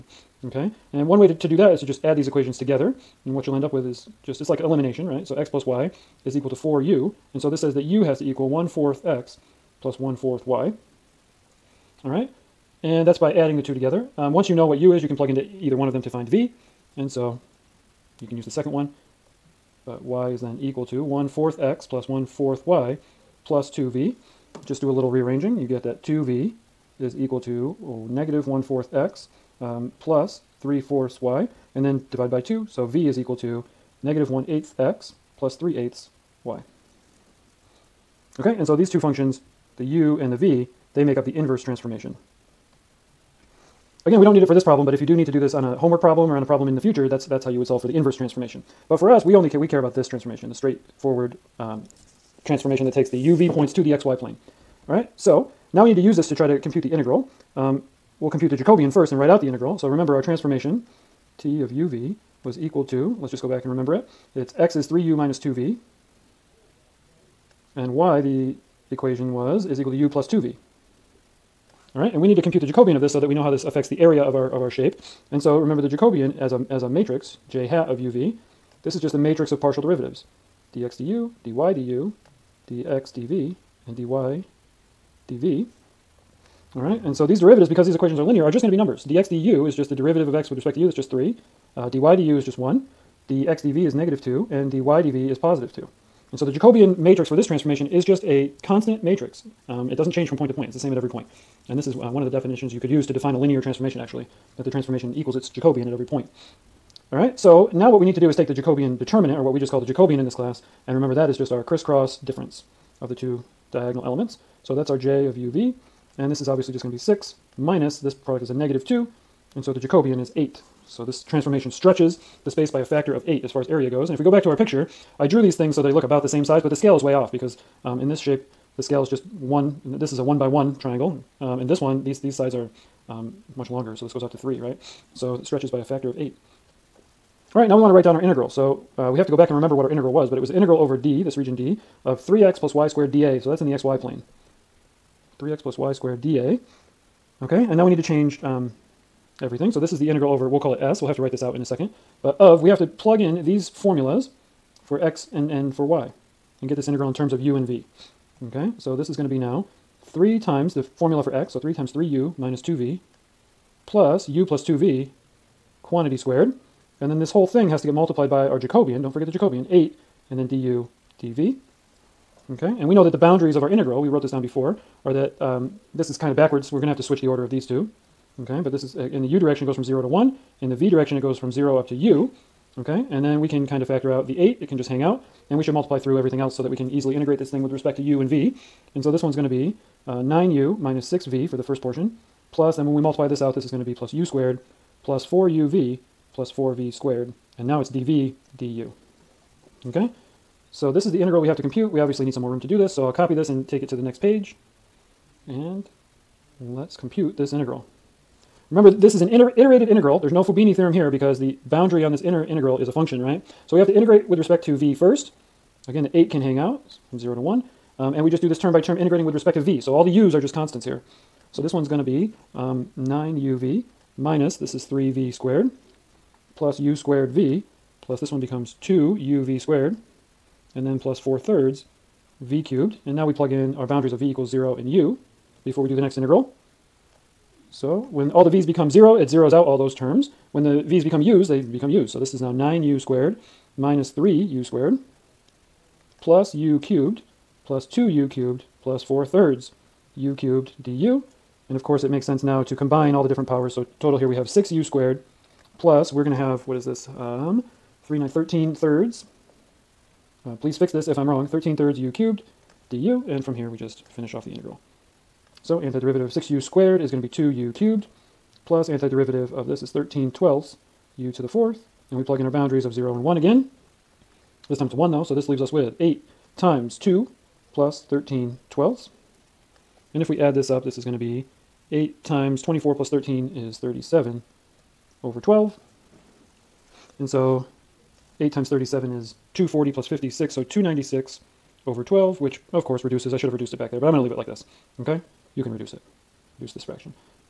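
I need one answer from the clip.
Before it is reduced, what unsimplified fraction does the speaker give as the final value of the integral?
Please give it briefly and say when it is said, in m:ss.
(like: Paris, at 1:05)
296/12, at 4:50.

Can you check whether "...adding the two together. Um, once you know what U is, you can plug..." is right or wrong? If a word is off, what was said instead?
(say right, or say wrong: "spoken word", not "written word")
right.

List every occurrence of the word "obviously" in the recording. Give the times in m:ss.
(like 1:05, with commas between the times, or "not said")
1:56, 3:21.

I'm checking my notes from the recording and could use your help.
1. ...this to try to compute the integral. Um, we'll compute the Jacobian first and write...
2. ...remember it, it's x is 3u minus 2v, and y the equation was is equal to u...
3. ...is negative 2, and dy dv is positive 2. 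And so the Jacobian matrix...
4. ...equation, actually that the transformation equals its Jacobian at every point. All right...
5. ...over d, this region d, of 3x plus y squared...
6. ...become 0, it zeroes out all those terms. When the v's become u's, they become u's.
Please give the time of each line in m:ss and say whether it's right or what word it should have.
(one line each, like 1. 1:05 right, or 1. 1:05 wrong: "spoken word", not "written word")
1. 0:56 right
2. 1:03 right
3. 1:33 right
4. 1:43 wrong: "transformation", not "equation"
5. 2:20 right
6. 3:58 right.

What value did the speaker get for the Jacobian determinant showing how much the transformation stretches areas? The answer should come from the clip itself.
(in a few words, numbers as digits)
8.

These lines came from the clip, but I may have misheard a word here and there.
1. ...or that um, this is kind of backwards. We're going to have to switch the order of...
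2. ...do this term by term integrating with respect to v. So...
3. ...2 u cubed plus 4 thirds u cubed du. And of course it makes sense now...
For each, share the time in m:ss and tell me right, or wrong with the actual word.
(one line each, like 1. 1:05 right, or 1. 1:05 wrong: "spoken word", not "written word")
1. 2:55 right
2. 3:38 right
3. 4:07 right.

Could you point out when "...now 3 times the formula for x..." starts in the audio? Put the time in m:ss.
2:39.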